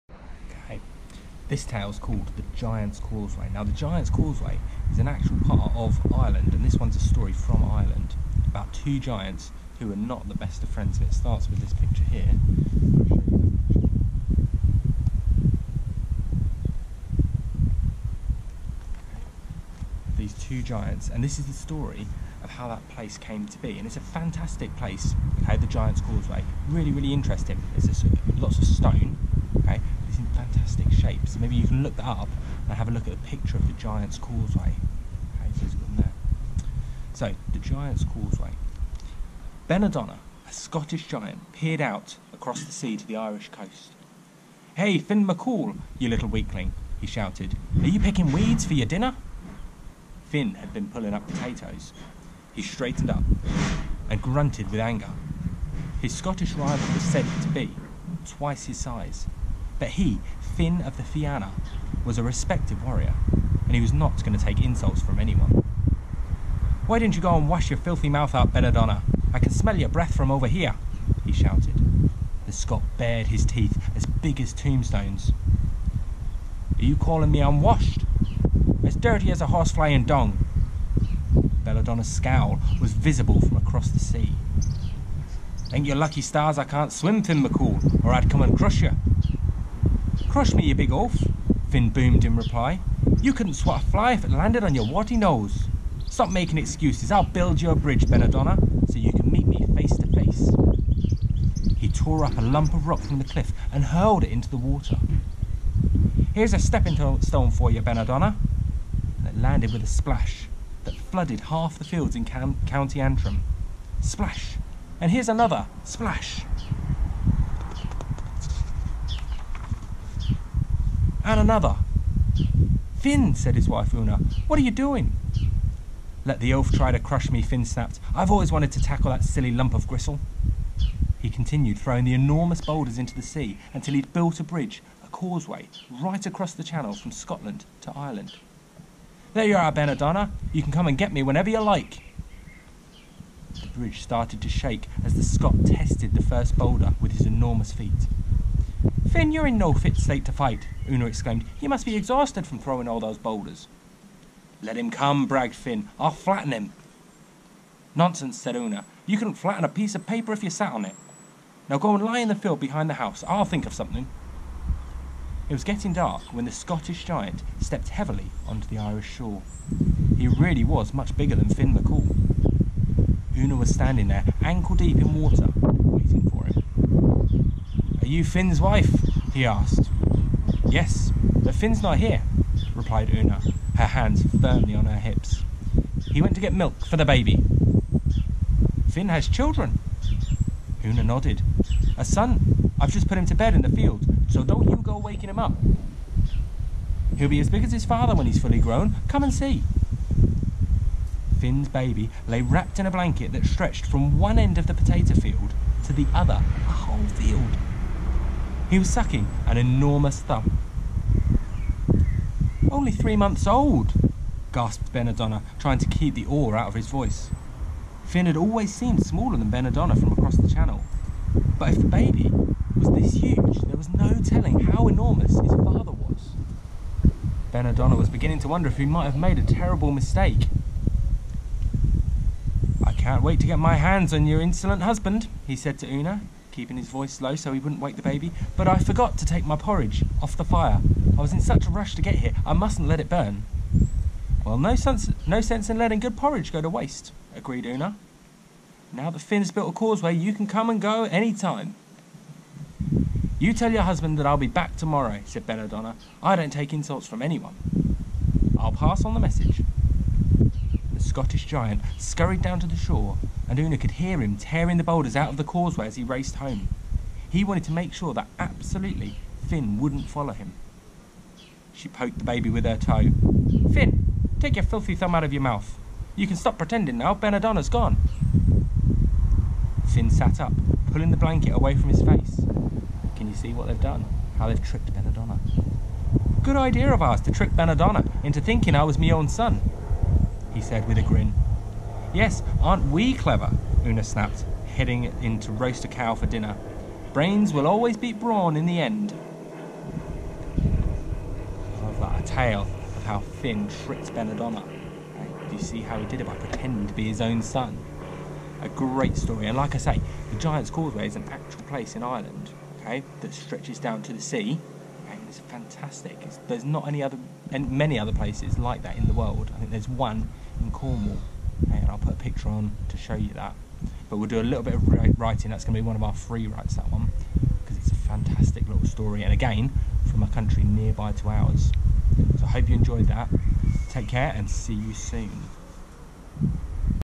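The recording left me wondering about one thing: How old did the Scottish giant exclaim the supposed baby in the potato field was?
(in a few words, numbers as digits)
3 months.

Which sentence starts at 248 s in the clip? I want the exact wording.
Now the Finn's built a causeway, you can come and go any time.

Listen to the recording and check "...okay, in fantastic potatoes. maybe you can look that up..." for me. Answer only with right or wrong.
wrong.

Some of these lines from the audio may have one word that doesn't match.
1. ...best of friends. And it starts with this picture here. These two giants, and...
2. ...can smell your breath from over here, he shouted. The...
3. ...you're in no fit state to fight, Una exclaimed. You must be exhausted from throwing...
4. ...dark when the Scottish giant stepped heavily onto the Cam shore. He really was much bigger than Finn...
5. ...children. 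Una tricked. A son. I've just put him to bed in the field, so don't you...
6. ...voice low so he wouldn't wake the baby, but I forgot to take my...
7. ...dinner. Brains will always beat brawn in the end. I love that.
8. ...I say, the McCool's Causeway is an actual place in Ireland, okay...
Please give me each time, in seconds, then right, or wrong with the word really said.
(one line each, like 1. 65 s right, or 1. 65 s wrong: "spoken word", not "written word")
1. 10 s right
2. 69 s right
3. 149 s right
4. 165 s wrong: "Irish", not "Cam"
5. 189 s wrong: "nodded", not "tricked"
6. 236 s right
7. 296 s right
8. 309 s wrong: "Giant", not "McCool".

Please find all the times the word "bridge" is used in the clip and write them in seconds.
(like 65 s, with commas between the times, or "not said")
97 s, 134 s, 143 s.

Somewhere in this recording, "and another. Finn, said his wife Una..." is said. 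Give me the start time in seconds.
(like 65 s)
121 s.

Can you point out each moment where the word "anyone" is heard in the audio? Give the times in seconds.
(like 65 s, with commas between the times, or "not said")
65 s, 257 s.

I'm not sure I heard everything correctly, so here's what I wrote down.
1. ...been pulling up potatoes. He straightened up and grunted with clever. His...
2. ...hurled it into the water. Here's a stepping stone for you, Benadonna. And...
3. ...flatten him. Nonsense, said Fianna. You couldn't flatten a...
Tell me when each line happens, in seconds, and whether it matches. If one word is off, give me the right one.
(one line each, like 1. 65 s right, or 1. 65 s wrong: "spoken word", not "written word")
1. 50 s wrong: "anger", not "clever"
2. 103 s right
3. 156 s wrong: "Una", not "Fianna".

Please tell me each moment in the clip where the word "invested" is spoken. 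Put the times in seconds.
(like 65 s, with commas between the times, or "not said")
not said.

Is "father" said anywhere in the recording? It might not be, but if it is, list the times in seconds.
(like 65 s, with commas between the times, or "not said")
197 s, 225 s.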